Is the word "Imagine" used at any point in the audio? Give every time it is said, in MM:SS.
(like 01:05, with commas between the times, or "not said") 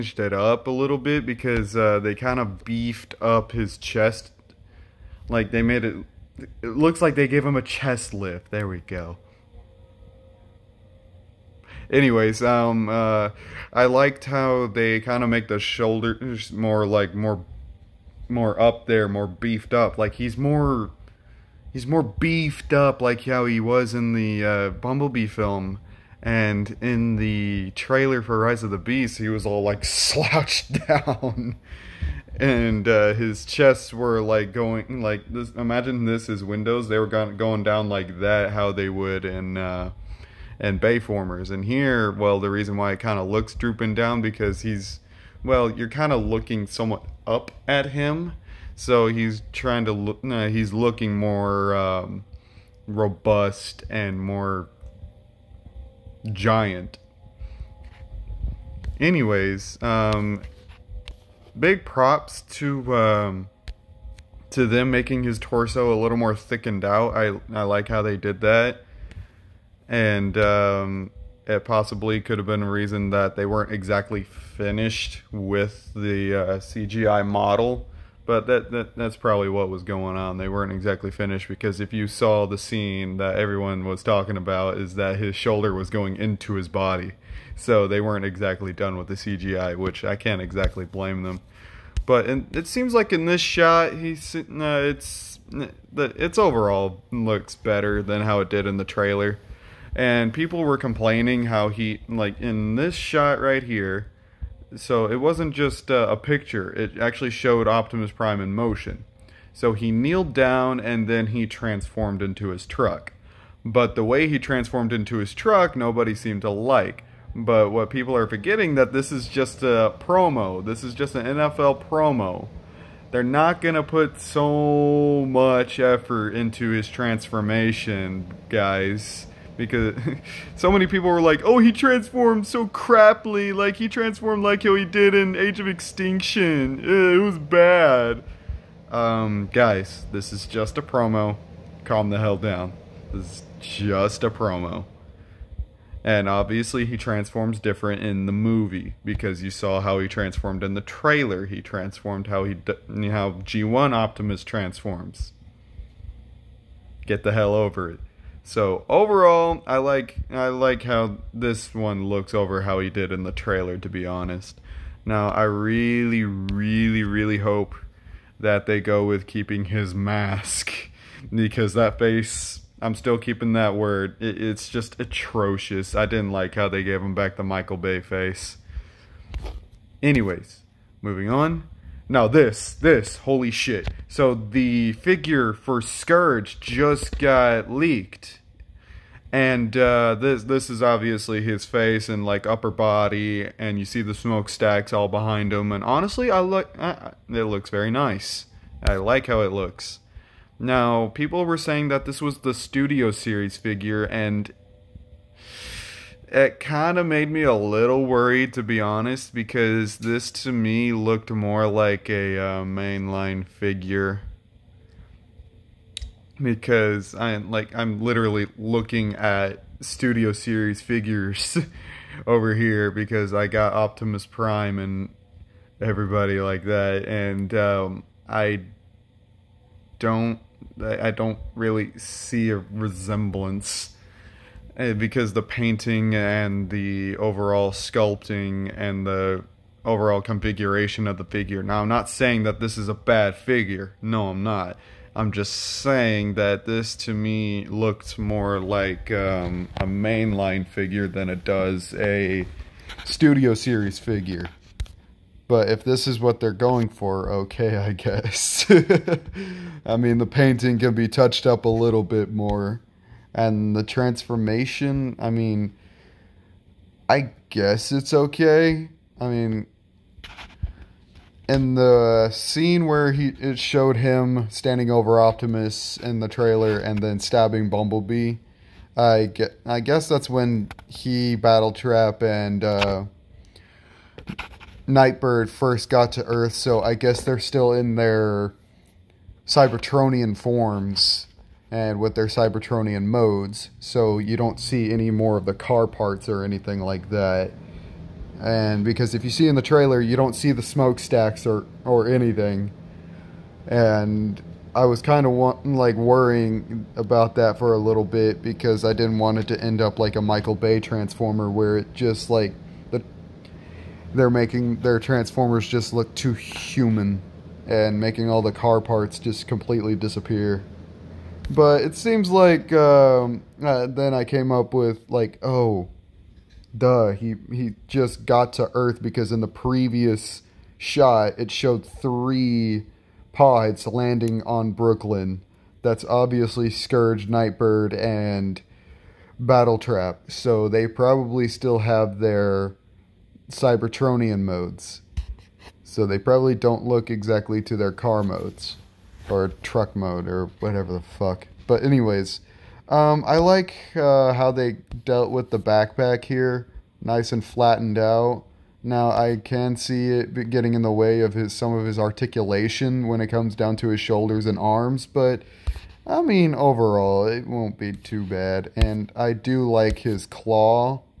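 00:35.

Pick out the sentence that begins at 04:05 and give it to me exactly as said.
I'm just saying that this to me looked more like um, a mainline figure than it does a studio series figure.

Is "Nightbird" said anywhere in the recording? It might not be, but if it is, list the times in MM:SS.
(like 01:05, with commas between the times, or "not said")
04:44, 05:37.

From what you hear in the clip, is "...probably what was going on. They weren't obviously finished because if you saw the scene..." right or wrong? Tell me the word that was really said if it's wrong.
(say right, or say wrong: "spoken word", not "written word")
wrong: "exactly", not "obviously".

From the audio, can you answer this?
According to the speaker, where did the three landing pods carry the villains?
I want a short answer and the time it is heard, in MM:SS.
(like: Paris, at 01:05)
Brooklyn, at 05:34.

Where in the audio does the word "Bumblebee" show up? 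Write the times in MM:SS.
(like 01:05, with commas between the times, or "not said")
00:24, 04:37.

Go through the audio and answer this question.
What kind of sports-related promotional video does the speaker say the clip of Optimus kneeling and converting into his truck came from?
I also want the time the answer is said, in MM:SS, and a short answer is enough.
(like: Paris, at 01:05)
NFL promo, at 02:01.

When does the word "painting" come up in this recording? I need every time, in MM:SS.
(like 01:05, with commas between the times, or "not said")
03:55, 04:20.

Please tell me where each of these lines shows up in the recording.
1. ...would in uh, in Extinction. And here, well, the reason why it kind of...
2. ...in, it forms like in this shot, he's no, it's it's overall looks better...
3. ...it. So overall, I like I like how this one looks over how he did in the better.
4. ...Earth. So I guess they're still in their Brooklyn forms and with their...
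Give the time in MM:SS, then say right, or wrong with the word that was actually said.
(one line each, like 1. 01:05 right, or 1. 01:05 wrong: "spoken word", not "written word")
1. 00:38 wrong: "Bayformers", not "Extinction"
2. 01:32 wrong: "seems", not "forms"
3. 02:37 wrong: "trailer", not "better"
4. 04:46 wrong: "Cybertronian", not "Brooklyn".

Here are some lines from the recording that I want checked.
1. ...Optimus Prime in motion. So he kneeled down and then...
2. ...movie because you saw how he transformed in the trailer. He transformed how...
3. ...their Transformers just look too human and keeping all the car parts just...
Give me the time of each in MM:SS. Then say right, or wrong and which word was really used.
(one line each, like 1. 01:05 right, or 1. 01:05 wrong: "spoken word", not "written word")
1. 01:47 right
2. 02:28 right
3. 05:14 wrong: "making", not "keeping".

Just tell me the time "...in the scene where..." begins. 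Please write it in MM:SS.
04:31.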